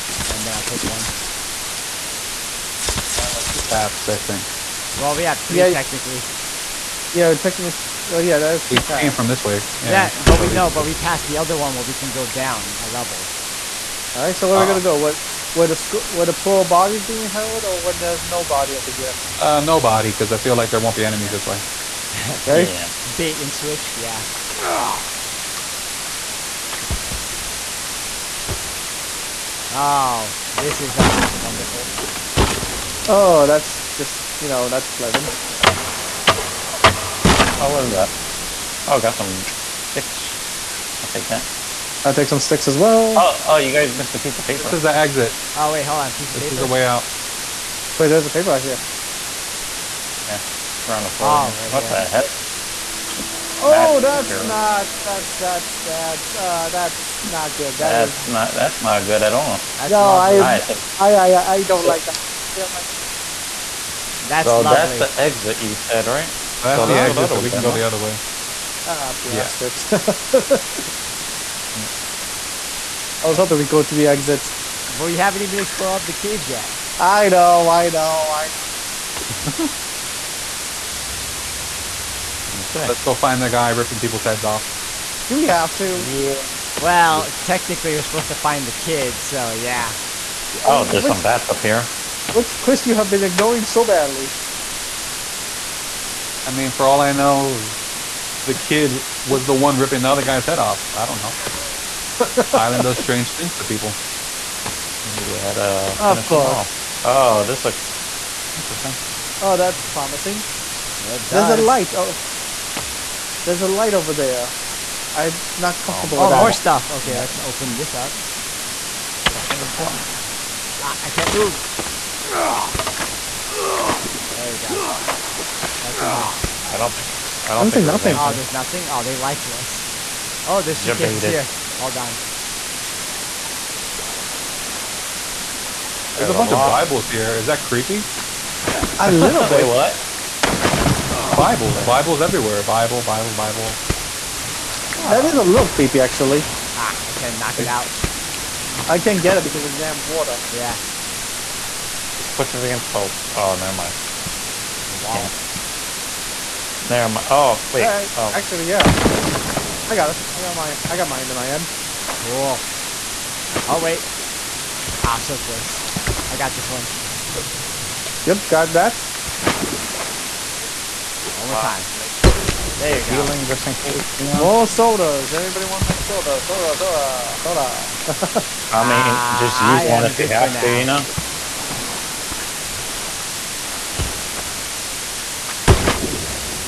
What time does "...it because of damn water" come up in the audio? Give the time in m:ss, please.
2:29.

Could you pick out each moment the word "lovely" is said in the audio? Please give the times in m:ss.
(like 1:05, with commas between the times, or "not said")
1:04.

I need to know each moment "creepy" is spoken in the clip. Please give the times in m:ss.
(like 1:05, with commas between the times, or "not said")
2:17, 2:25.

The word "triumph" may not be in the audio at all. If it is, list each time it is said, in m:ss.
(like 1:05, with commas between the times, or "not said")
not said.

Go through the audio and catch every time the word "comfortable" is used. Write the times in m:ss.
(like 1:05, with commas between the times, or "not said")
1:55.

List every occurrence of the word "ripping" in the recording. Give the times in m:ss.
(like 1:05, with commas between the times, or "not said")
1:23, 1:39.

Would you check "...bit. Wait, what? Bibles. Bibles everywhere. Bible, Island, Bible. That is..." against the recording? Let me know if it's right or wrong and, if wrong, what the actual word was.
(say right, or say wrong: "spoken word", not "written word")
wrong: "Bible", not "Island".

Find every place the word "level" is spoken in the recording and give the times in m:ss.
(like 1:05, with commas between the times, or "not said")
0:12.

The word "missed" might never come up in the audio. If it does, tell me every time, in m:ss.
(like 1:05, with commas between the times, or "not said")
0:43.